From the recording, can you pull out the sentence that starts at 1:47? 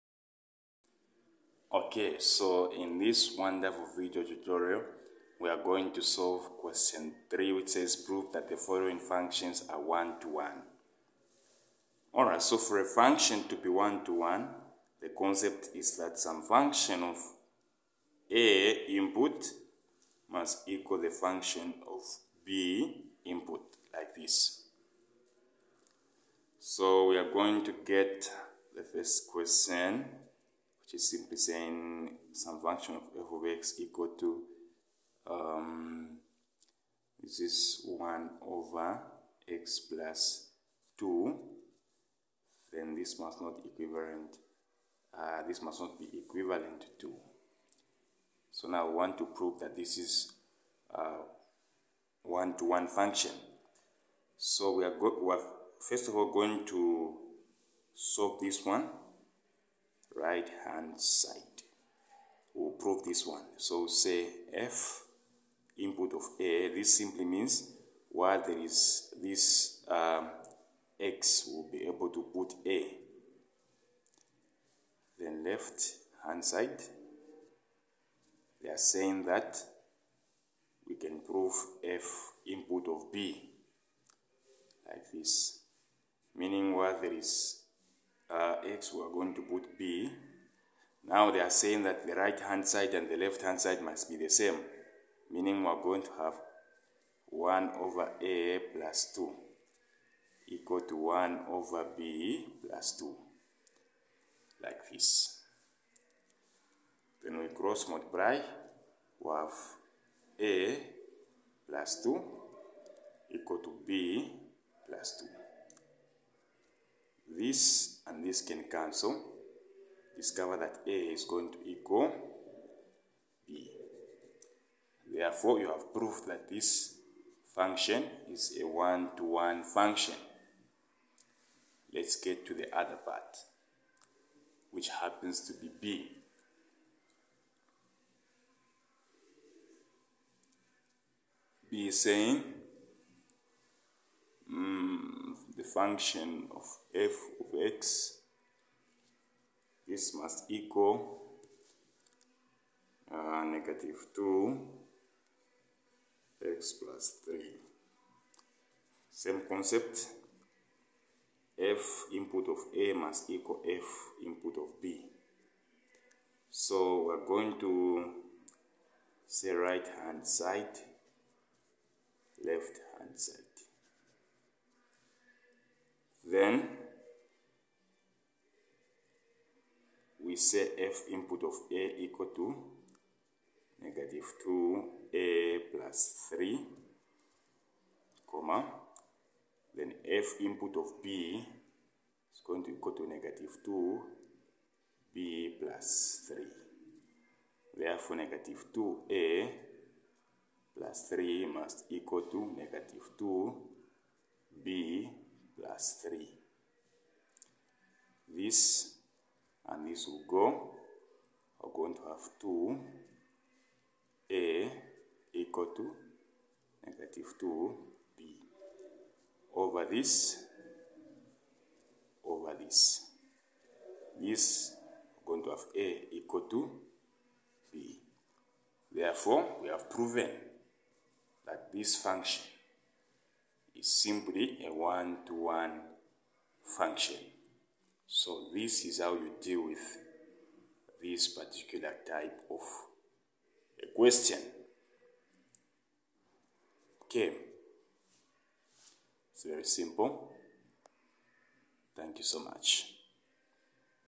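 Then we cross multiply, we have A plus 2 equal to B plus 2.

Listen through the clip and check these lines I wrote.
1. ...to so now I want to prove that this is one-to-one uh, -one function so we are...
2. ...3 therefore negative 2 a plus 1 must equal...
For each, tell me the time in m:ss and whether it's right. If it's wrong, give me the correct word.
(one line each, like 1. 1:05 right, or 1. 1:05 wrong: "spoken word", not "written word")
1. 0:46 right
2. 3:16 wrong: "3", not "1".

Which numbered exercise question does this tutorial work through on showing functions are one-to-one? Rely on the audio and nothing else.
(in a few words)
Question 3.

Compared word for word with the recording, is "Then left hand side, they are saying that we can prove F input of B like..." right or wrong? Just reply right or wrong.
right.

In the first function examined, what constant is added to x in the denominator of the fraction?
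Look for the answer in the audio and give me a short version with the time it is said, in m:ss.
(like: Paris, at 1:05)
2, at 0:37.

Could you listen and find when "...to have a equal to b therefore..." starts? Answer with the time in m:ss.
3:45.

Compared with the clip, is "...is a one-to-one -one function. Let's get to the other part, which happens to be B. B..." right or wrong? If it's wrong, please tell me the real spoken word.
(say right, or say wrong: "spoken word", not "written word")
right.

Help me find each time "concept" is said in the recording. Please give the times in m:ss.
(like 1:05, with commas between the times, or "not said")
0:15, 2:39.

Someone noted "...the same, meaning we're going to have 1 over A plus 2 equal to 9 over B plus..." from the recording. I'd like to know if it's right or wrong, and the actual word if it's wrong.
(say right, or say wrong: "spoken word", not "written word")
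wrong: "1", not "9".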